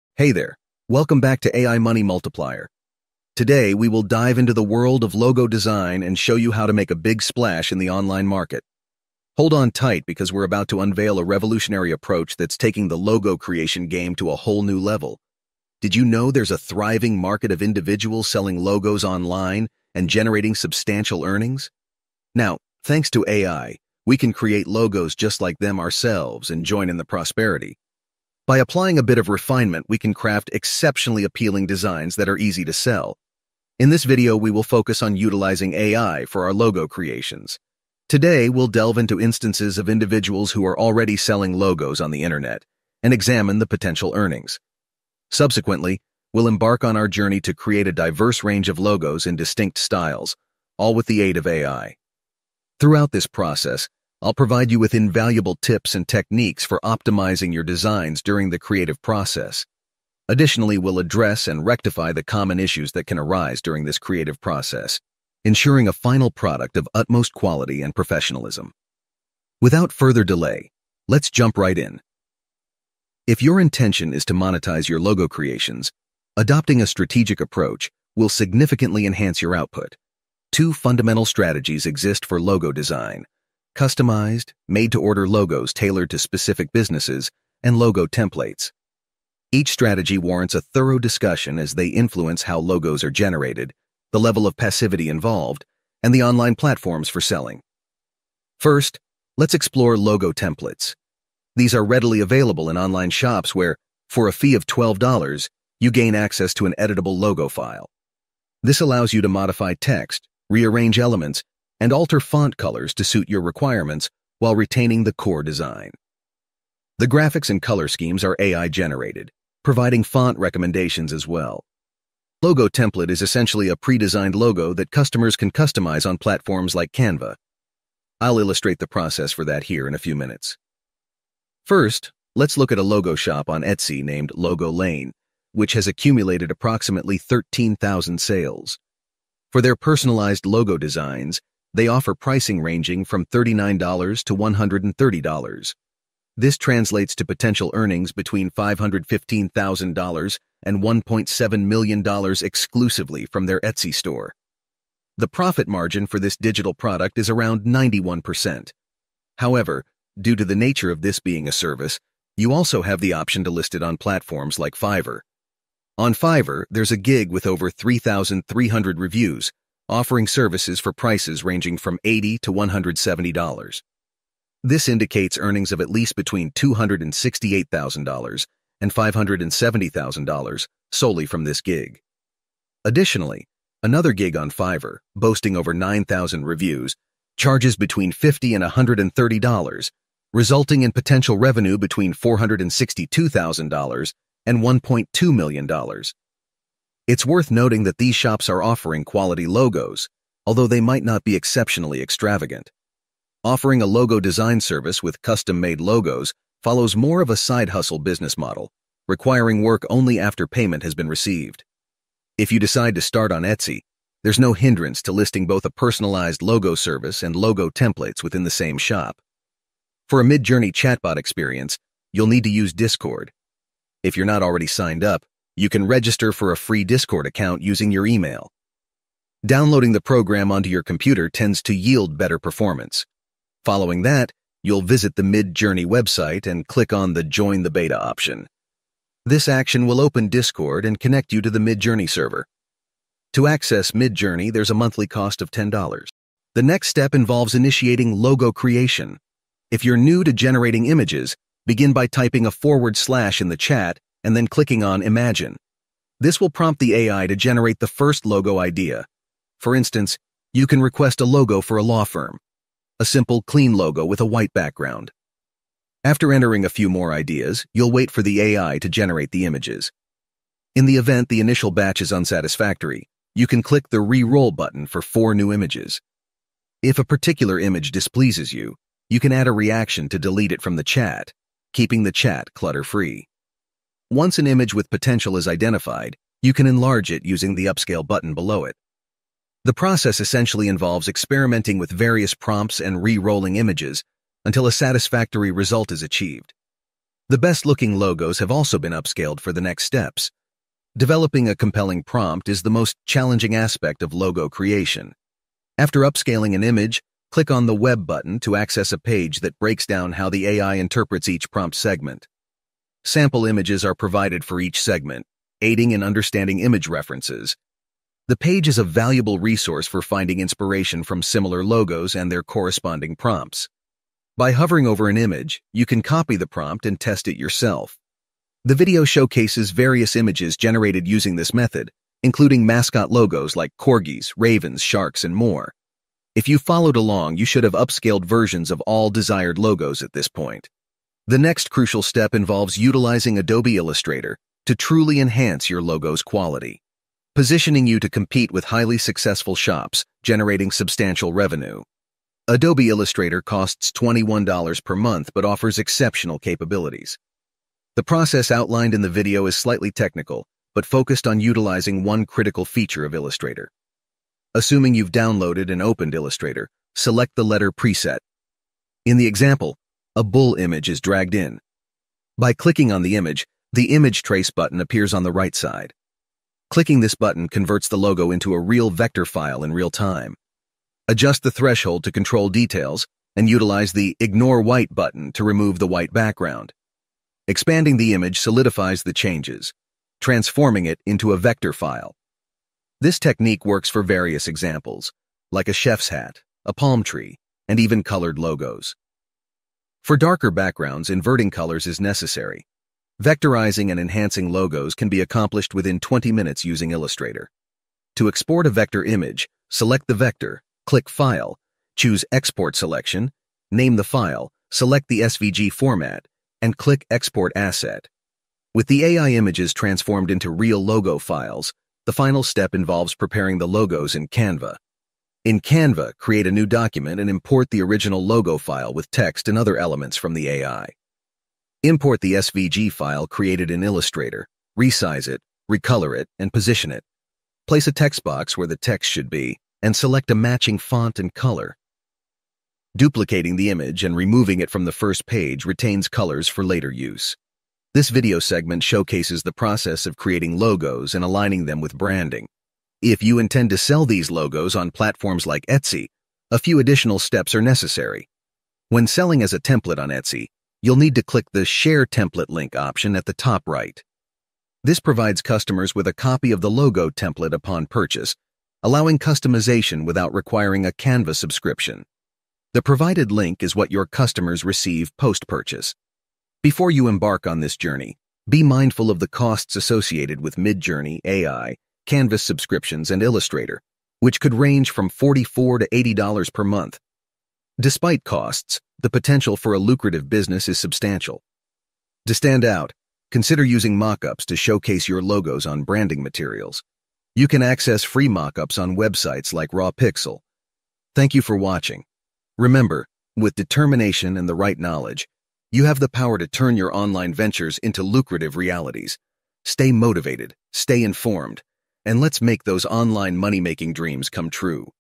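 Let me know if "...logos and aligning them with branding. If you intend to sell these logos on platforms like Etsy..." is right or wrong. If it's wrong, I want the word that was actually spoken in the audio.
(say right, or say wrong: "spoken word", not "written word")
right.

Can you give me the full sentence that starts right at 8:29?
Stay motivated, stay informed, and let's make those online money making dreams come true.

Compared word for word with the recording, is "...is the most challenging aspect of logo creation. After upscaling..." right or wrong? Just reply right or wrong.
right.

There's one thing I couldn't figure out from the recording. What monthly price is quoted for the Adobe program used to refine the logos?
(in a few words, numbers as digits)
$21.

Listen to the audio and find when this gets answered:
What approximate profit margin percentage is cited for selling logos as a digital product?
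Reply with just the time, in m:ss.
2:37.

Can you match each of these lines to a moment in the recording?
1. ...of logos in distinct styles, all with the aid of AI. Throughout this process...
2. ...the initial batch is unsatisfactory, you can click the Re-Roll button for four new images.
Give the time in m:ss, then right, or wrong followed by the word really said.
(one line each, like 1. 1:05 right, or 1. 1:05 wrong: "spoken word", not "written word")
1. 0:48 right
2. 4:31 right.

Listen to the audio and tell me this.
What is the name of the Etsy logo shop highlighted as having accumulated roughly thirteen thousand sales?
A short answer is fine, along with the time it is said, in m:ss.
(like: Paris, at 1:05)
Logo Lane, at 2:14.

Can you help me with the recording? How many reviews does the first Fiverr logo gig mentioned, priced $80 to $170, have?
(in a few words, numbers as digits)
over 3,300.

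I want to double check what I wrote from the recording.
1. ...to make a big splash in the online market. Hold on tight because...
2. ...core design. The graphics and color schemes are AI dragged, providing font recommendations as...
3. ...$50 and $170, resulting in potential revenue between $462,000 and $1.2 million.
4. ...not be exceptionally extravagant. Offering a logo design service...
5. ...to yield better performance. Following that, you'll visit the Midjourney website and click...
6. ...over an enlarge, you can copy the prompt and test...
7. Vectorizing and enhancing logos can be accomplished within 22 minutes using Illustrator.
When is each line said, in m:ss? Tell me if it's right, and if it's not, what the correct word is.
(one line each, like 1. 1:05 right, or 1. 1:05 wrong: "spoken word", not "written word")
1. 0:06 right
2. 1:55 wrong: "generated", not "dragged"
3. 3:08 wrong: "130", not "170"
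4. 3:21 right
5. 3:51 right
6. 5:24 wrong: "image", not "enlarge"
7. 6:43 wrong: "20", not "22".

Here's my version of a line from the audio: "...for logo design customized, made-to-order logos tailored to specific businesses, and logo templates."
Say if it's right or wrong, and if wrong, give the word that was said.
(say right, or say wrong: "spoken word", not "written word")
right.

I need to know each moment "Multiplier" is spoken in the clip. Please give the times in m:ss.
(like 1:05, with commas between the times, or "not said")
0:02.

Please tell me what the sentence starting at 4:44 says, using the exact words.
Once an image with potential is identified, you can enlarge it using the upscale button below it.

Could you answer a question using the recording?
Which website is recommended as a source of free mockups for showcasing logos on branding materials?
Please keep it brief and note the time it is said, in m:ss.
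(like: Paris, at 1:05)
RawPixel, at 8:19.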